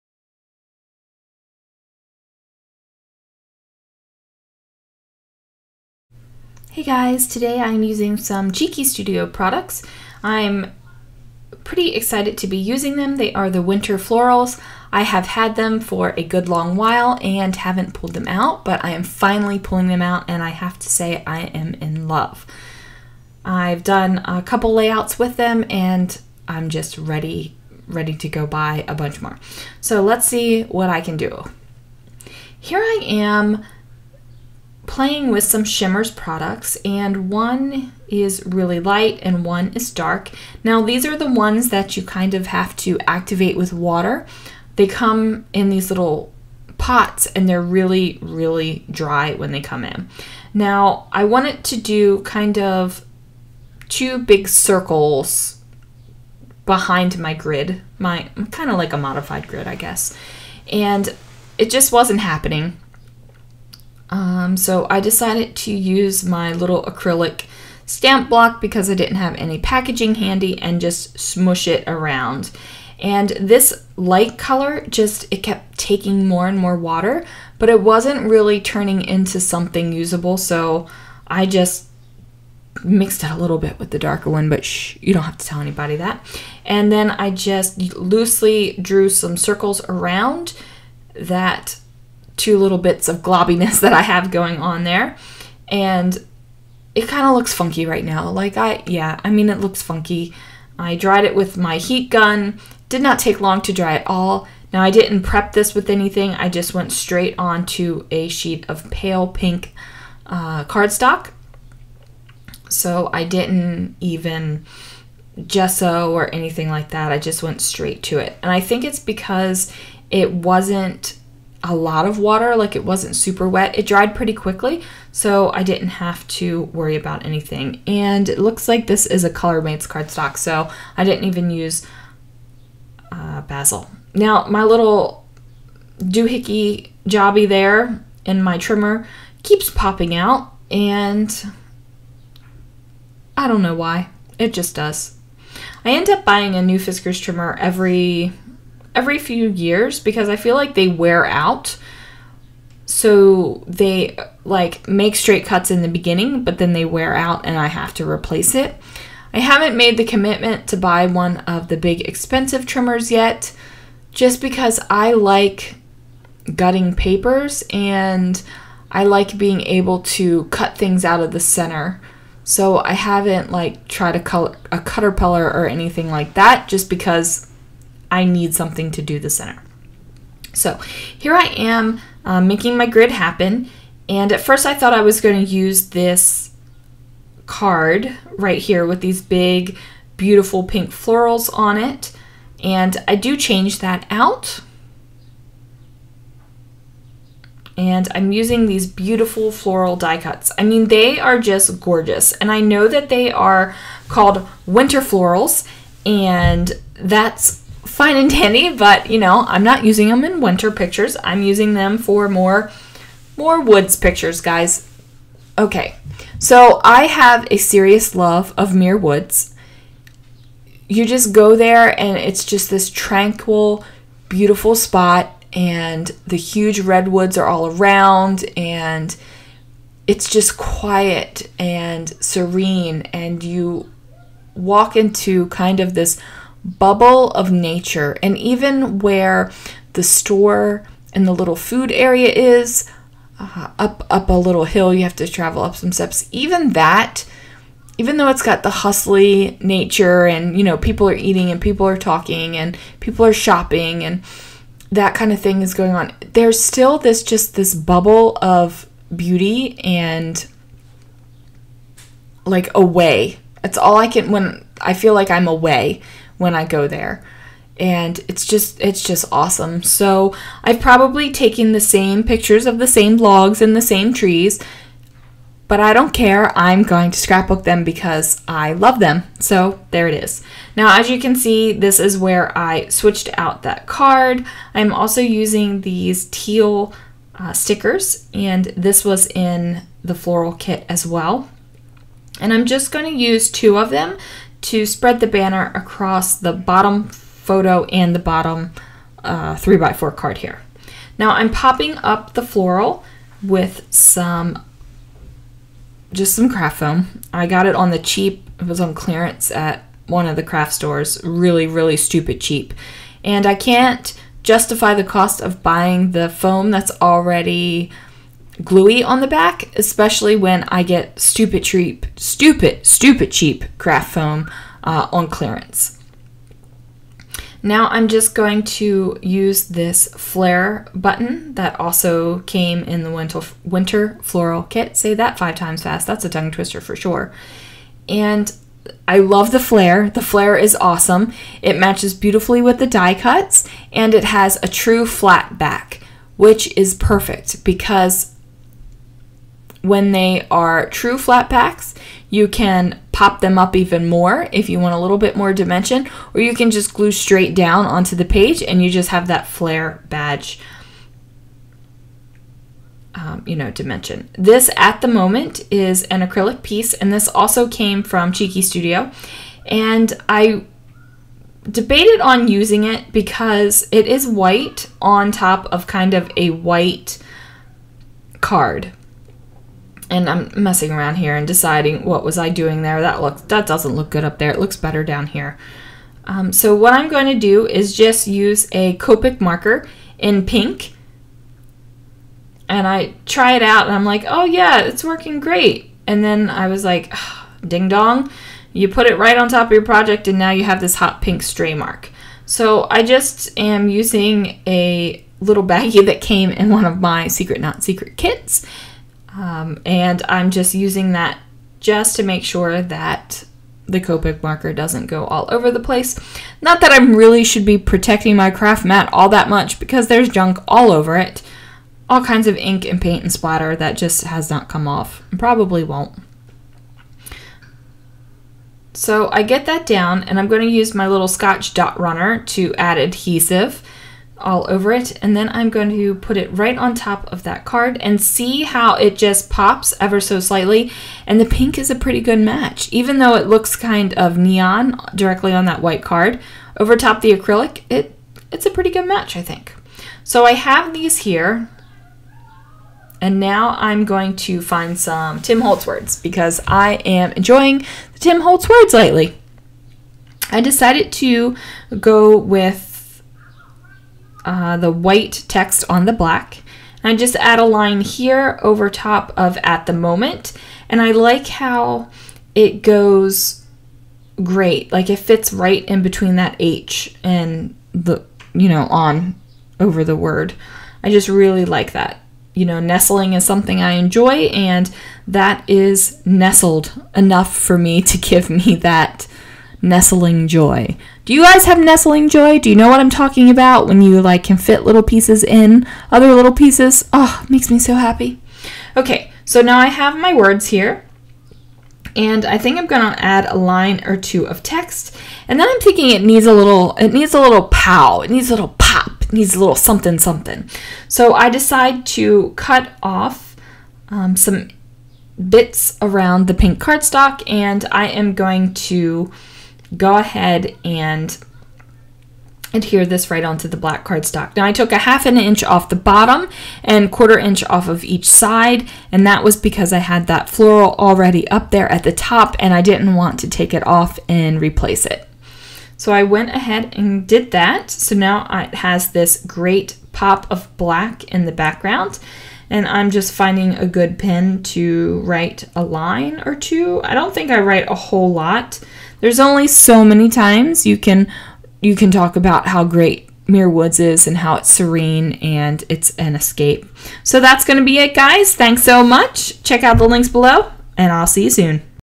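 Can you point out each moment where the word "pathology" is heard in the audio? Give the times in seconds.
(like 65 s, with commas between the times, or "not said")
not said.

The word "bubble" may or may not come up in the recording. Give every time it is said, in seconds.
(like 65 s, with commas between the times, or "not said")
236 s, 257 s.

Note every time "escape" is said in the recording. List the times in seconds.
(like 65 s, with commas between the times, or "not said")
556 s.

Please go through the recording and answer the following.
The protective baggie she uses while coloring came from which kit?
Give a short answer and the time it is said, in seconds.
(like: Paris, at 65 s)
Secret Not Secret, at 407 s.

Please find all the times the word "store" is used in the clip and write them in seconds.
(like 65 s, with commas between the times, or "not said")
240 s, 310 s.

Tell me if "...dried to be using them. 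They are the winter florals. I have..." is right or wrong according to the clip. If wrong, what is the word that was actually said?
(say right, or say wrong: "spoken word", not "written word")
wrong: "excited", not "dried".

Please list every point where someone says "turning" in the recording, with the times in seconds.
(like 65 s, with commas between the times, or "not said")
78 s.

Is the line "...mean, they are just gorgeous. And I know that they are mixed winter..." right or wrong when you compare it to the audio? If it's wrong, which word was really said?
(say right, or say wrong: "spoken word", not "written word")
wrong: "called", not "mixed".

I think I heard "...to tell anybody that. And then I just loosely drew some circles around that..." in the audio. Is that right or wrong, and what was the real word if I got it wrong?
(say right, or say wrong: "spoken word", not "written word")
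right.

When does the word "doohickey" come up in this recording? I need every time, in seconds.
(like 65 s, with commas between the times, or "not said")
135 s.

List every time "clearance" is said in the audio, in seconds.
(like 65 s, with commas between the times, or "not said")
308 s, 325 s.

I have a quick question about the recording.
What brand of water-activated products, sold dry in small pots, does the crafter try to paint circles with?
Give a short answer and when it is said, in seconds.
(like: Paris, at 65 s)
Shimmerz, at 35 s.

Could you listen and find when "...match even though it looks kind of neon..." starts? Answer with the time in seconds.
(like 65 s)
442 s.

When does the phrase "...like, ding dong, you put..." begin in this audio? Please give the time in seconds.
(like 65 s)
396 s.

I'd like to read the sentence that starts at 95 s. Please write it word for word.
And it kind of looks funky right now.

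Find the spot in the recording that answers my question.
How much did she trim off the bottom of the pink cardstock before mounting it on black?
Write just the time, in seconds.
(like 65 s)
524 s.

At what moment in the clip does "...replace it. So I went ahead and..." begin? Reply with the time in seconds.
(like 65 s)
534 s.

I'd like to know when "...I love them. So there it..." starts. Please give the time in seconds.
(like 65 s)
278 s.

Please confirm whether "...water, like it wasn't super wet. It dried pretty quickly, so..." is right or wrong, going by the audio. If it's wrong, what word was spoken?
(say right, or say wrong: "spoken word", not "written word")
right.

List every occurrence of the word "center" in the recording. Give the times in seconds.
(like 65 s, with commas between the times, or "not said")
171 s, 179 s.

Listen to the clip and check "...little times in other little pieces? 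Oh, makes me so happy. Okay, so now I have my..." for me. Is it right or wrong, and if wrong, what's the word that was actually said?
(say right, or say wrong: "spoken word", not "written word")
wrong: "pieces", not "times".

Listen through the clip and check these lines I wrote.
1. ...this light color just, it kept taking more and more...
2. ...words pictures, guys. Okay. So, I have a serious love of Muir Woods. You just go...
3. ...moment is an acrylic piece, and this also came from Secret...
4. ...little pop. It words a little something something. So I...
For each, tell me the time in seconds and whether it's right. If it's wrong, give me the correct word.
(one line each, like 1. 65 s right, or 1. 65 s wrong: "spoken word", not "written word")
1. 73 s right
2. 213 s wrong: "woods", not "words"
3. 365 s wrong: "Cheeky", not "Secret"
4. 508 s wrong: "needs", not "words".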